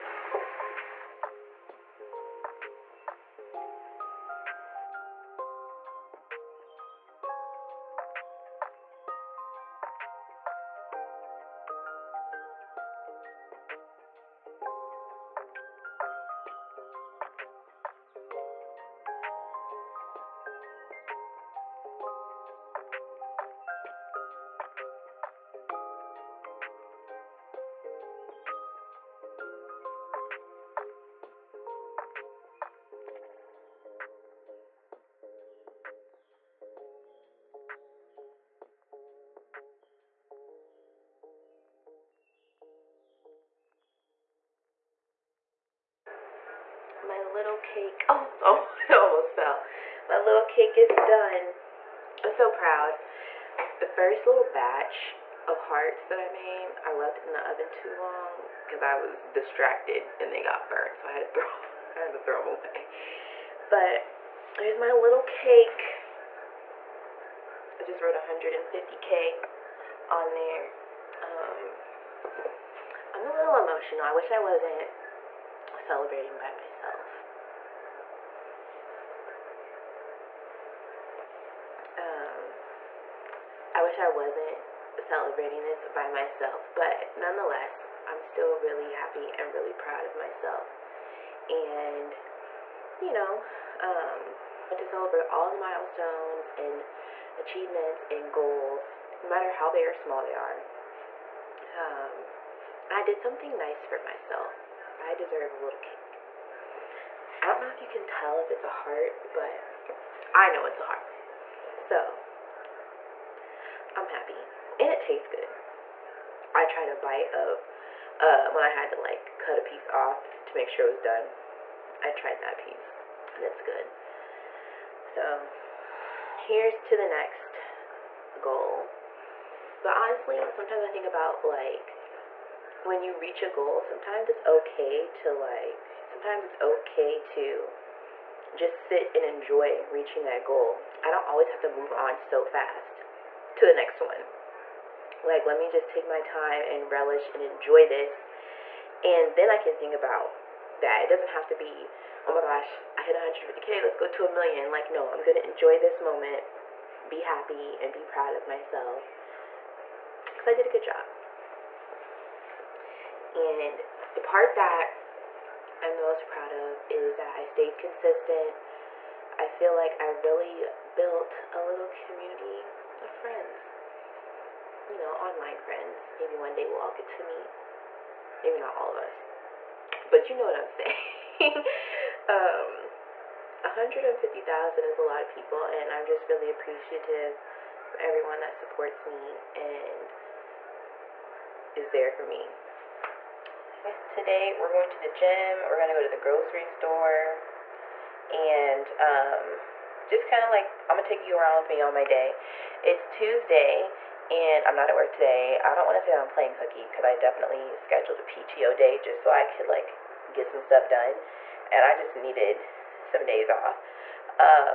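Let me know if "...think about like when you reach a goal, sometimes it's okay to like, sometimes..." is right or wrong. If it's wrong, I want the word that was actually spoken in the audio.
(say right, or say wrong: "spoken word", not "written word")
right.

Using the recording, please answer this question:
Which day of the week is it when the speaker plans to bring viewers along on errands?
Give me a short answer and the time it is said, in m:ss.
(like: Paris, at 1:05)
Tuesday, at 3:23.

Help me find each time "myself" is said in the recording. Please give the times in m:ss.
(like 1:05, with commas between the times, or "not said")
1:16, 1:26, 1:30, 1:43, 2:38.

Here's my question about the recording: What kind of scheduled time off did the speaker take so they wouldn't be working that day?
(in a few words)
PTO day.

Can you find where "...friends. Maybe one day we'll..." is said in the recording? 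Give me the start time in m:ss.
2:55.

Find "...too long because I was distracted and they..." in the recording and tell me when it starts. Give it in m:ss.
0:57.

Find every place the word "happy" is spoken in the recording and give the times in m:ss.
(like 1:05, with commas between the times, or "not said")
1:28, 1:54, 2:37.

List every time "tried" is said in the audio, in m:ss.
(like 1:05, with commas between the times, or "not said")
1:56, 2:02.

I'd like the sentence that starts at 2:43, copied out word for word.
And the part that I'm the most proud of is that I stayed consistent.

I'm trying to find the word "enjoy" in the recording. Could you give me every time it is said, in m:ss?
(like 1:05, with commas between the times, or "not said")
2:19, 2:27, 2:35.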